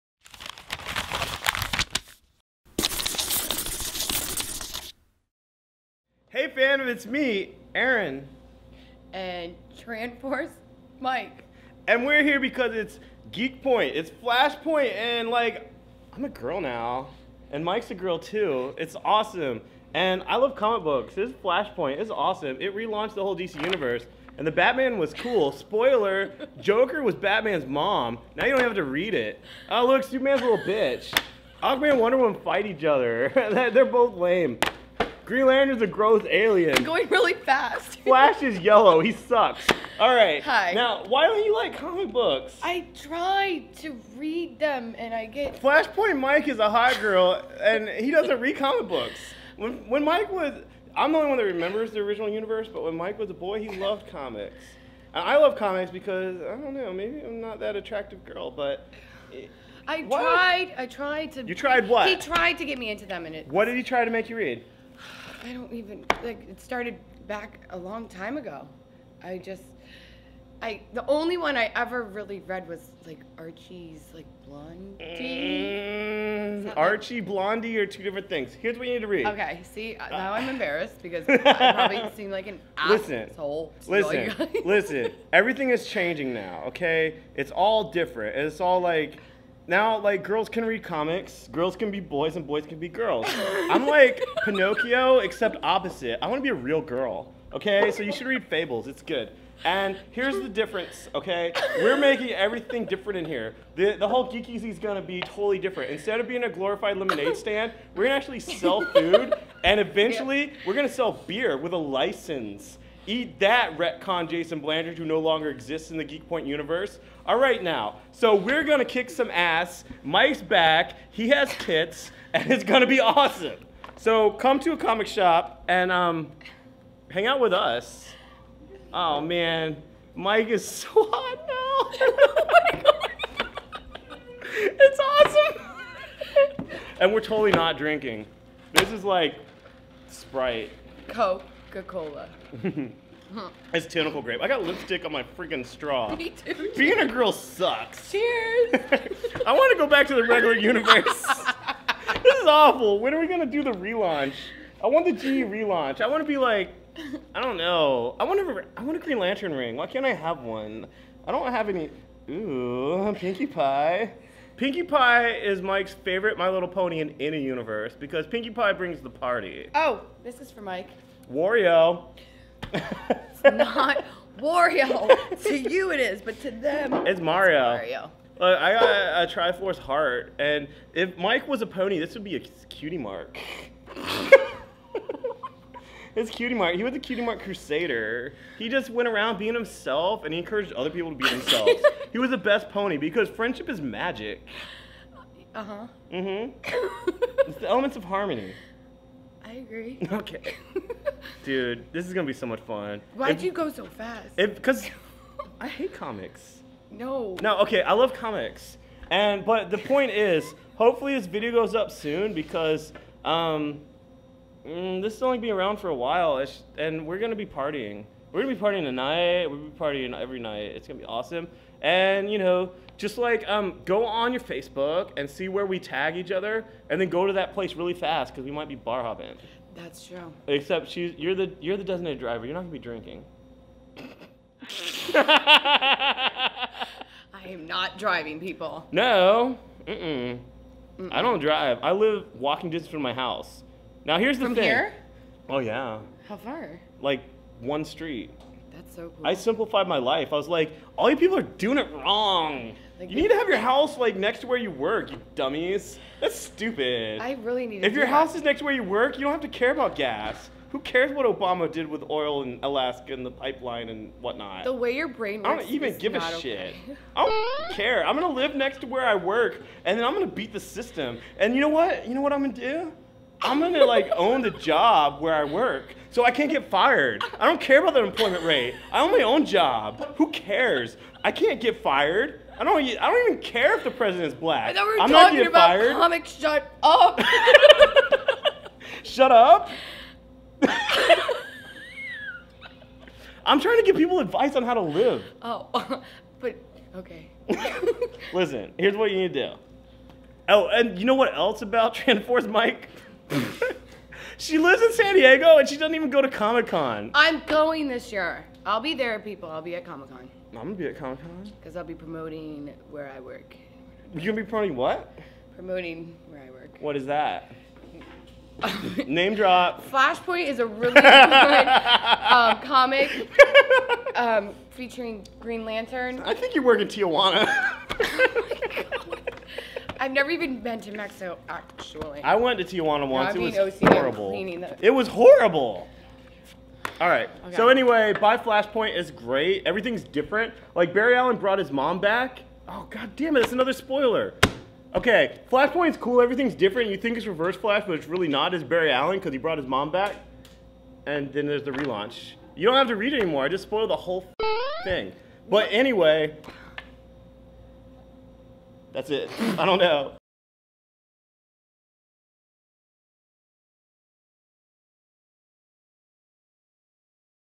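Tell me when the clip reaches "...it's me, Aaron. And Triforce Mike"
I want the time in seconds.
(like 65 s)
6 s.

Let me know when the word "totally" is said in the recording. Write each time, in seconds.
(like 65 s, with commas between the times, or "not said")
105 s, 137 s.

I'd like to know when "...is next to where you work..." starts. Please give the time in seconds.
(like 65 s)
258 s.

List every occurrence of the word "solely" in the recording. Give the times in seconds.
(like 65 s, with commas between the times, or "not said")
not said.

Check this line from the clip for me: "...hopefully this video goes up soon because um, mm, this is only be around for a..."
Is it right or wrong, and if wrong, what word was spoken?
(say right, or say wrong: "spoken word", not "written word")
right.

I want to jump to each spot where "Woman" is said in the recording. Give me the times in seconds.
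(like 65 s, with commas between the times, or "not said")
32 s.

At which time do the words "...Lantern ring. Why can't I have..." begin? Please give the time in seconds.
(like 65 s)
159 s.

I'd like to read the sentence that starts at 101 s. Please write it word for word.
We're making everything different in here.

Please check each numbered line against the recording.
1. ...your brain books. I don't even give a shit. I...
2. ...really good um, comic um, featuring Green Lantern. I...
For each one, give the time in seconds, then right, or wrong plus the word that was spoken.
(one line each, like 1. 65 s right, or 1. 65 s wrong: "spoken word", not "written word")
1. 264 s wrong: "works", not "books"
2. 320 s right.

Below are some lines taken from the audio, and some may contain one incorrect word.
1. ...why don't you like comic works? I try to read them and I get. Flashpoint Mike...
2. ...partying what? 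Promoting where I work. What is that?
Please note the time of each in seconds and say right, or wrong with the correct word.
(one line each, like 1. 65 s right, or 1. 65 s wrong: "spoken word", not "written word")
1. 41 s wrong: "books", not "works"
2. 314 s wrong: "promoting", not "partying".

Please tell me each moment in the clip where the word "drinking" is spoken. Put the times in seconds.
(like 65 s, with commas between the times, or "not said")
137 s, 232 s.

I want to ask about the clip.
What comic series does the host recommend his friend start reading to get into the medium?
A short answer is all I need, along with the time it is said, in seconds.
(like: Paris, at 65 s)
Fables, at 98 s.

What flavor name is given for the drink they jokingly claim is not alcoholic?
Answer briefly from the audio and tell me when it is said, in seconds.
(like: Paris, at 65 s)
Tentacle grape, at 143 s.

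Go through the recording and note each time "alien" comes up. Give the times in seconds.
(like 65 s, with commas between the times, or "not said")
36 s.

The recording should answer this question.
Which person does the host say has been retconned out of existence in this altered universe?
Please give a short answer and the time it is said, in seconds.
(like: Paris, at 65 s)
Jason Blanchard, at 114 s.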